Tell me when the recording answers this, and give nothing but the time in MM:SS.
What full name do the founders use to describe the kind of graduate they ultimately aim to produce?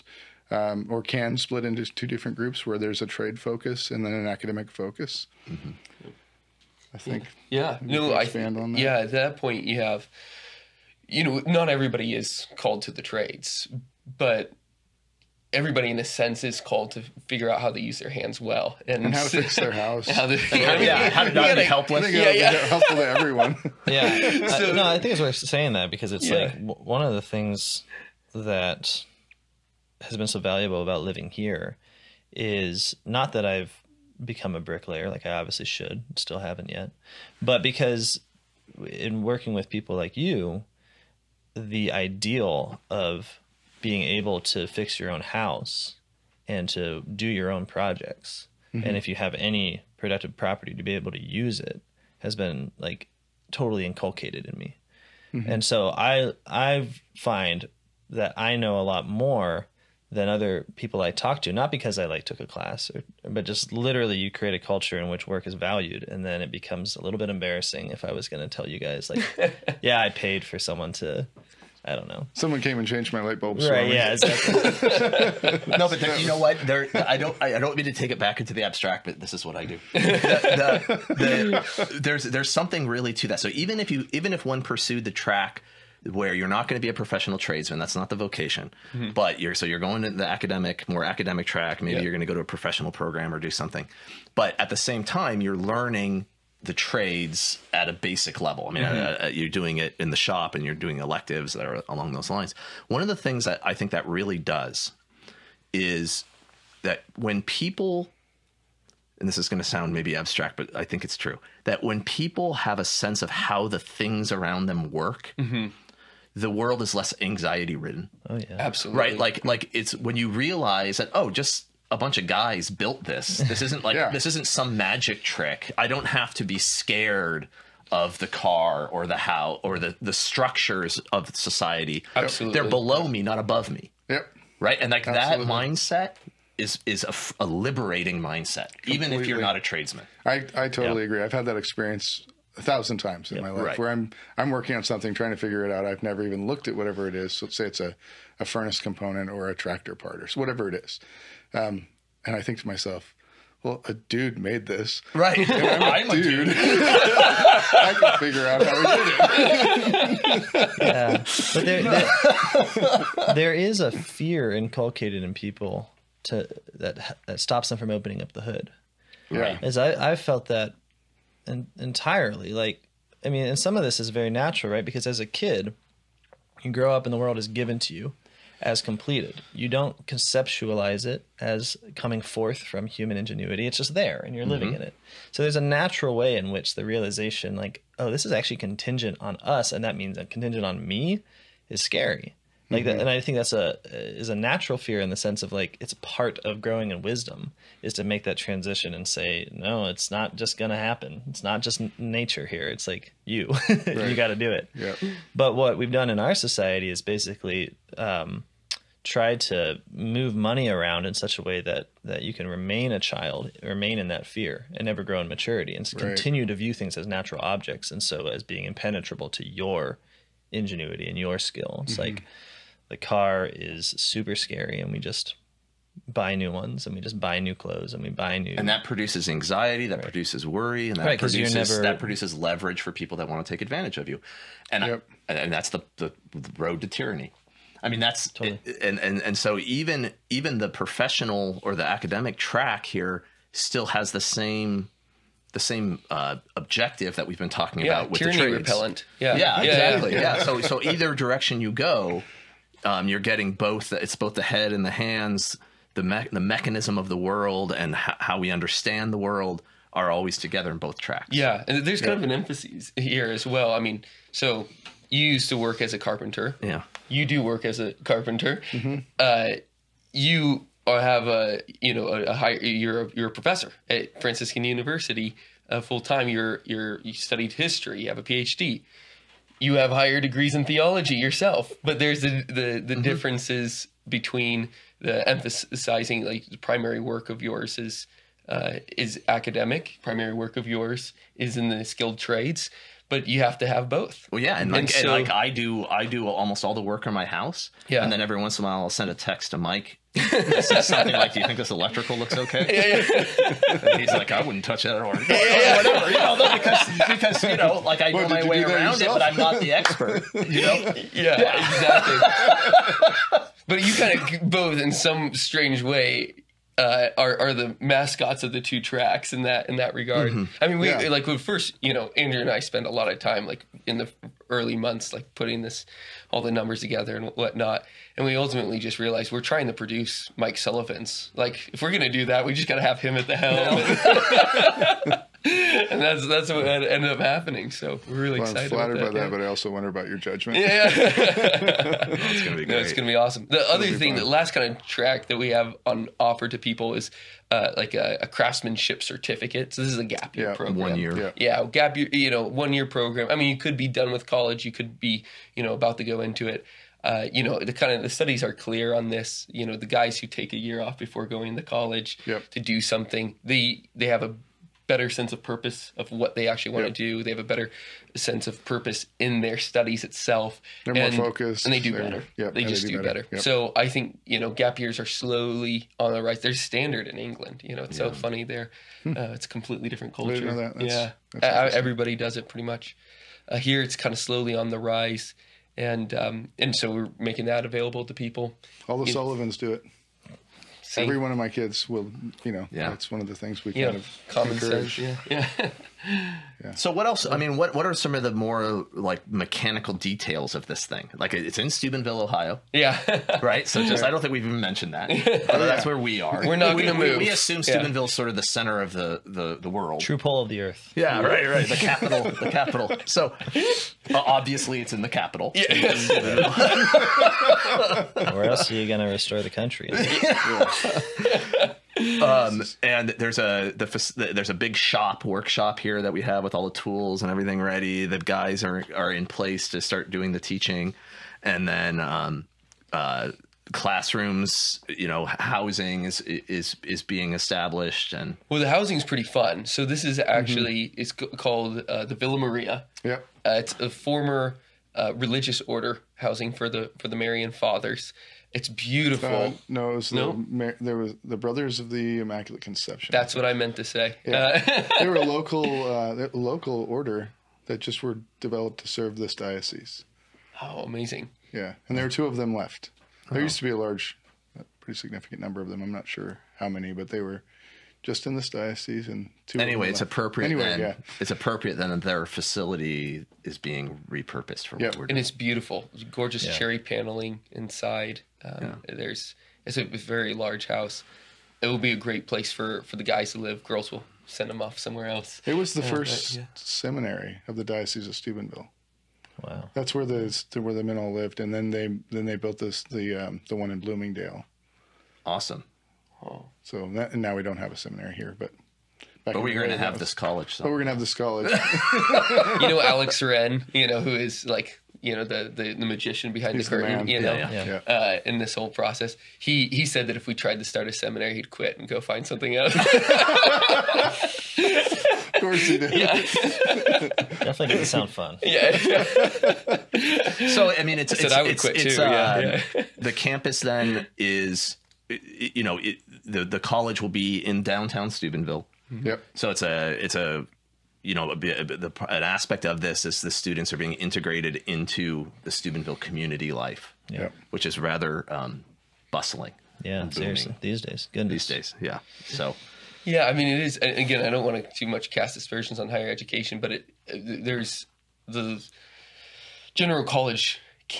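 05:30.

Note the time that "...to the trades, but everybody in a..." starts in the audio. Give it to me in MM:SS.
00:12.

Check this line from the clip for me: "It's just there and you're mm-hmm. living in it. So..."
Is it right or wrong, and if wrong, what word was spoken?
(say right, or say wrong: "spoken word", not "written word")
right.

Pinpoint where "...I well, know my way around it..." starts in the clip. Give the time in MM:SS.
05:08.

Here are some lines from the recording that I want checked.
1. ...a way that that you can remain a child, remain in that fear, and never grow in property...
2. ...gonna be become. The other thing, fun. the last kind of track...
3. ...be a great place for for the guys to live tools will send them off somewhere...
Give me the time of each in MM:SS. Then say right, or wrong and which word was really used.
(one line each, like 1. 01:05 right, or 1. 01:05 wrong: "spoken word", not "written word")
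1. 03:31 wrong: "maturity", not "property"
2. 05:42 wrong: "awesome", not "become"
3. 08:01 wrong: "girls", not "tools".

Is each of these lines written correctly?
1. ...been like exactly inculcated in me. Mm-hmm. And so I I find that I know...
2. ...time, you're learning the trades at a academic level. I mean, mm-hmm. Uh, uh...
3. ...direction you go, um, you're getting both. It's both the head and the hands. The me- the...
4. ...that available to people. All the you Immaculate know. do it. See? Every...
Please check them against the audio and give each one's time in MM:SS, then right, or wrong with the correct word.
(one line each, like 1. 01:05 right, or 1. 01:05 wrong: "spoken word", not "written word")
1. 00:52 wrong: "totally", not "exactly"
2. 01:35 wrong: "basic", not "academic"
3. 04:11 right
4. 06:27 wrong: "Sullivans", not "Immaculate".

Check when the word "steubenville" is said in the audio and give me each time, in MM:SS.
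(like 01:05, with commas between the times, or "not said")
06:41, 06:47, 08:08, 08:48, 08:55.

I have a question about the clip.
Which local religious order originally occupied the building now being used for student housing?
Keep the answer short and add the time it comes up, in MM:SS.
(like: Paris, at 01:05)
Brothers of the Immaculate Conception, at 07:31.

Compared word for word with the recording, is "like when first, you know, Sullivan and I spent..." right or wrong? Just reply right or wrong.
wrong.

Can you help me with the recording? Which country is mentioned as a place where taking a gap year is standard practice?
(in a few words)
England.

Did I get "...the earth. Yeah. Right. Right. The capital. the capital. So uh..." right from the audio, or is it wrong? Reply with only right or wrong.
right.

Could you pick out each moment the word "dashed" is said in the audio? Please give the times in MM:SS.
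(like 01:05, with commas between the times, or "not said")
not said.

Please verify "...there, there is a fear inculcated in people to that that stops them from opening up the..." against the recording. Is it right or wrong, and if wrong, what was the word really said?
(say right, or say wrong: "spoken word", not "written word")
right.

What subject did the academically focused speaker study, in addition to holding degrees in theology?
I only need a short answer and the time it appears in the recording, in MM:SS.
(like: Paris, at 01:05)
History, at 04:37.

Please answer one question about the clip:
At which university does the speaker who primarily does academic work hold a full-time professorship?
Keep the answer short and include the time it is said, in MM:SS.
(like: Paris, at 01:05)
Franciscan University, at 04:34.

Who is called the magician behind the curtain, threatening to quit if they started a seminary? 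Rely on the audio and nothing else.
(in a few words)
Alex Wren.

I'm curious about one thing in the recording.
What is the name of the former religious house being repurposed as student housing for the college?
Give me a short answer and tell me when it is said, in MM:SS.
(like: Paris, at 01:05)
Villa Maria, at 07:22.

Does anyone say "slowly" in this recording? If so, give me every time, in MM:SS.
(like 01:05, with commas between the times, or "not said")
06:15, 06:24.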